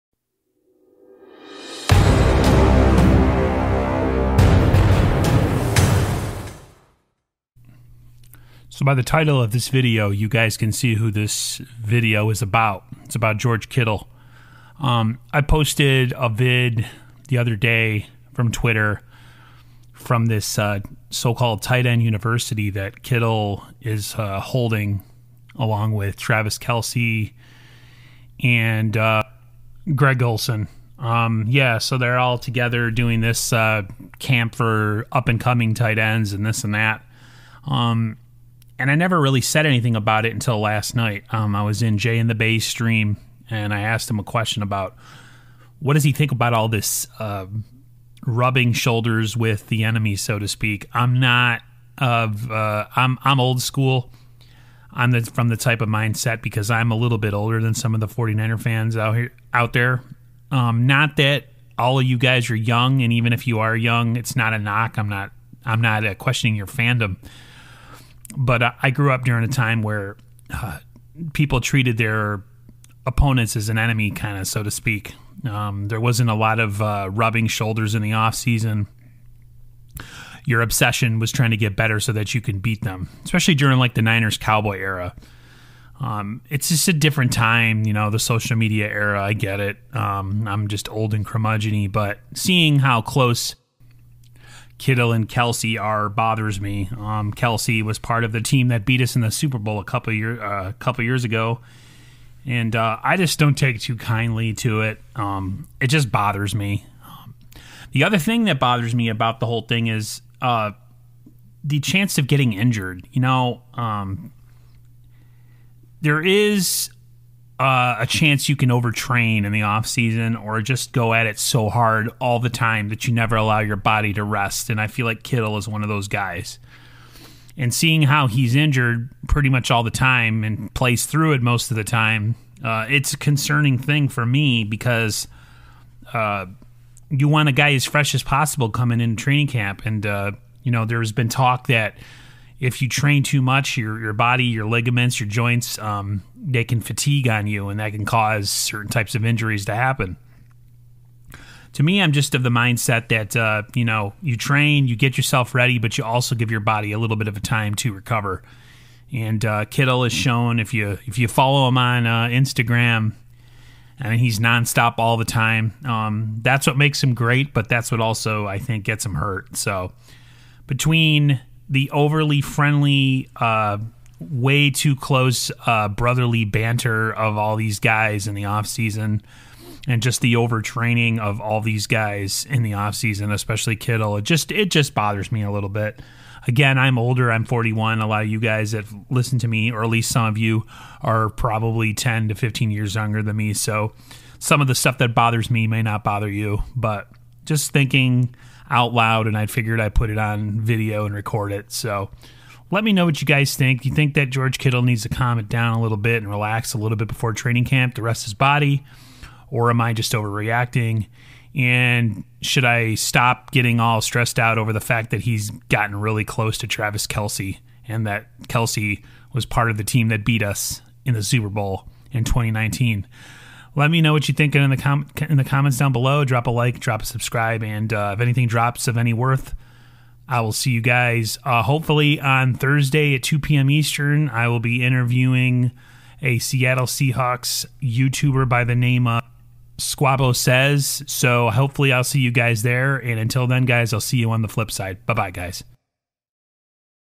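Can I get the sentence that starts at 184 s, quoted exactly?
It just it just bothers me a little bit.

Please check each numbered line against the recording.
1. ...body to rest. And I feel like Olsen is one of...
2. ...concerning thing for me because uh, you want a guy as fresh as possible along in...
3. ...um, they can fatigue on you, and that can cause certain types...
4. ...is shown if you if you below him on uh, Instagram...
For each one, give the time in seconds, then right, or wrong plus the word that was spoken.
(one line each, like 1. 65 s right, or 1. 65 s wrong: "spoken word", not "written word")
1. 123 s wrong: "Kittle", not "Olsen"
2. 133 s wrong: "coming", not "along"
3. 145 s right
4. 160 s wrong: "follow", not "below".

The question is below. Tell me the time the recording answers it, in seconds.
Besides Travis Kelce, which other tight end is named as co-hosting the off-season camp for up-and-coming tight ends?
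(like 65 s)
29 s.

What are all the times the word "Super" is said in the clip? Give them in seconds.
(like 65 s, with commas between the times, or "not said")
99 s, 221 s.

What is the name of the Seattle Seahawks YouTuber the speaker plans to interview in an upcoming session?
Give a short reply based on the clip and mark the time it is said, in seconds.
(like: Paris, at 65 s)
Squabo Says, at 239 s.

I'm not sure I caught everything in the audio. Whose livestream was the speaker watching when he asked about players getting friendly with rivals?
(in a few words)
Jay in the Bay.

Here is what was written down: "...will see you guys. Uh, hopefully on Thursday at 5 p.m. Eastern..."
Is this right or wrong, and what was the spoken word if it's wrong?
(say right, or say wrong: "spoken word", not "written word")
wrong: "2", not "5".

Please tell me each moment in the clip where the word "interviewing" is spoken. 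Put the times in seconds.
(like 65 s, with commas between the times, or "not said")
234 s.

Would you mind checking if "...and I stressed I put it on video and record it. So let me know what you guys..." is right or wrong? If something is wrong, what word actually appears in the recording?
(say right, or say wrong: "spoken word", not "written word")
wrong: "figured", not "stressed".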